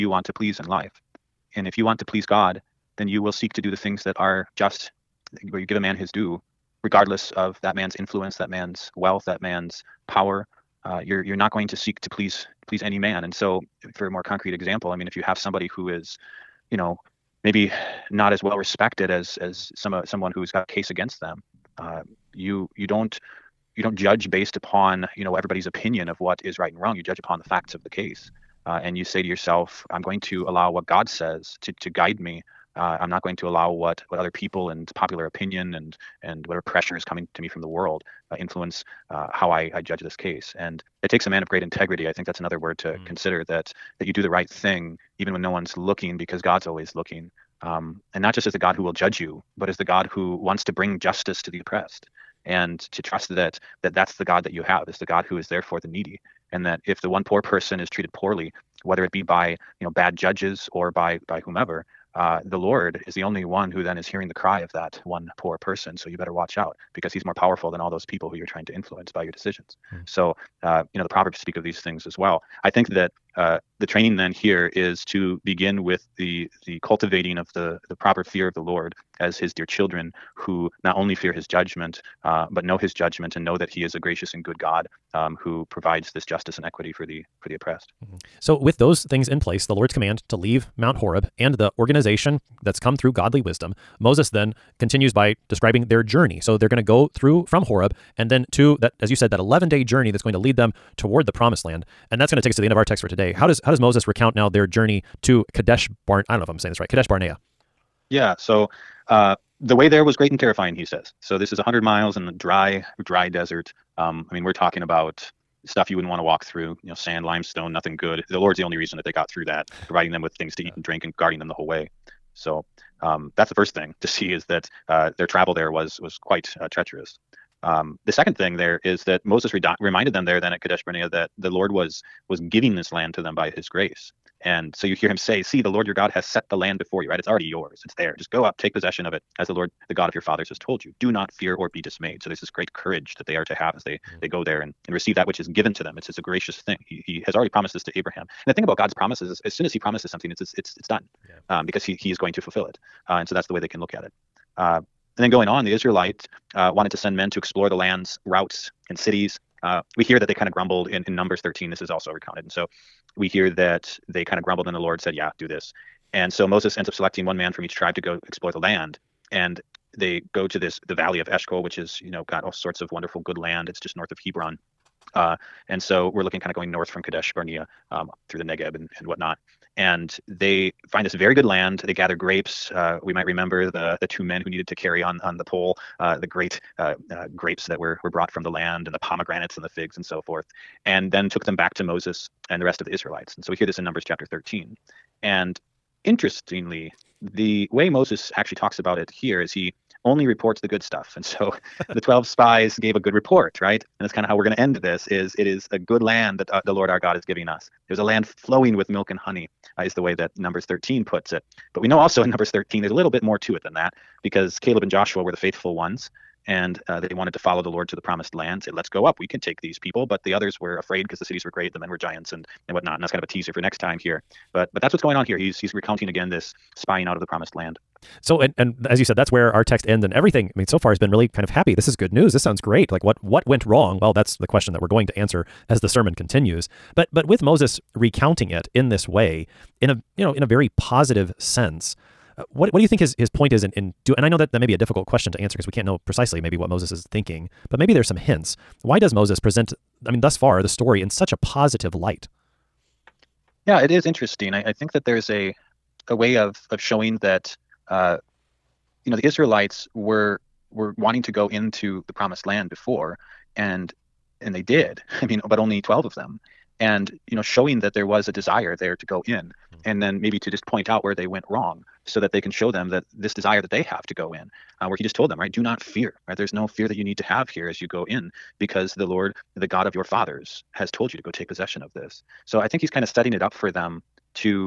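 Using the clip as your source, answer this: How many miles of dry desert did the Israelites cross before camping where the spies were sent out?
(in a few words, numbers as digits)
100.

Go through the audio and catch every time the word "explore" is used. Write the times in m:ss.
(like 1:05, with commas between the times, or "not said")
2:37, 2:48.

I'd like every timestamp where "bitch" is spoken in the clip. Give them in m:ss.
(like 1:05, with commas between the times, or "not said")
not said.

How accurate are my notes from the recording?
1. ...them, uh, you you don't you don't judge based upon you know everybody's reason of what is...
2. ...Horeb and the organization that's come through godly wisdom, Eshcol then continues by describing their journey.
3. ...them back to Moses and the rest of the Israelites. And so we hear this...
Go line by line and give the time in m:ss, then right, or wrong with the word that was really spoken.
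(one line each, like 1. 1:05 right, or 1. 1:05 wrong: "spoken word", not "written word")
1. 0:21 wrong: "opinion", not "reason"
2. 1:30 wrong: "Moses", not "Eshcol"
3. 3:11 right.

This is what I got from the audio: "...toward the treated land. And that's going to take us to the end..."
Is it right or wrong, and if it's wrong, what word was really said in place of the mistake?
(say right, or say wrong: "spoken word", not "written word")
wrong: "promised", not "treated".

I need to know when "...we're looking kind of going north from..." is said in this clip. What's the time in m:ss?
2:56.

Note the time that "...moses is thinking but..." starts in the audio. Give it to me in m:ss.
4:06.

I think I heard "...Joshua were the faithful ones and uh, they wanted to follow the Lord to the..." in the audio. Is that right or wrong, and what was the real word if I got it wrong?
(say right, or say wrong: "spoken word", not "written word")
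right.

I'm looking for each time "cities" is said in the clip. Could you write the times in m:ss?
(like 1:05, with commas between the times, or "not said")
2:38, 3:41.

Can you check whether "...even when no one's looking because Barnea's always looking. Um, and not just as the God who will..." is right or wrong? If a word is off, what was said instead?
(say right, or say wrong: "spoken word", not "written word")
wrong: "God", not "Barnea".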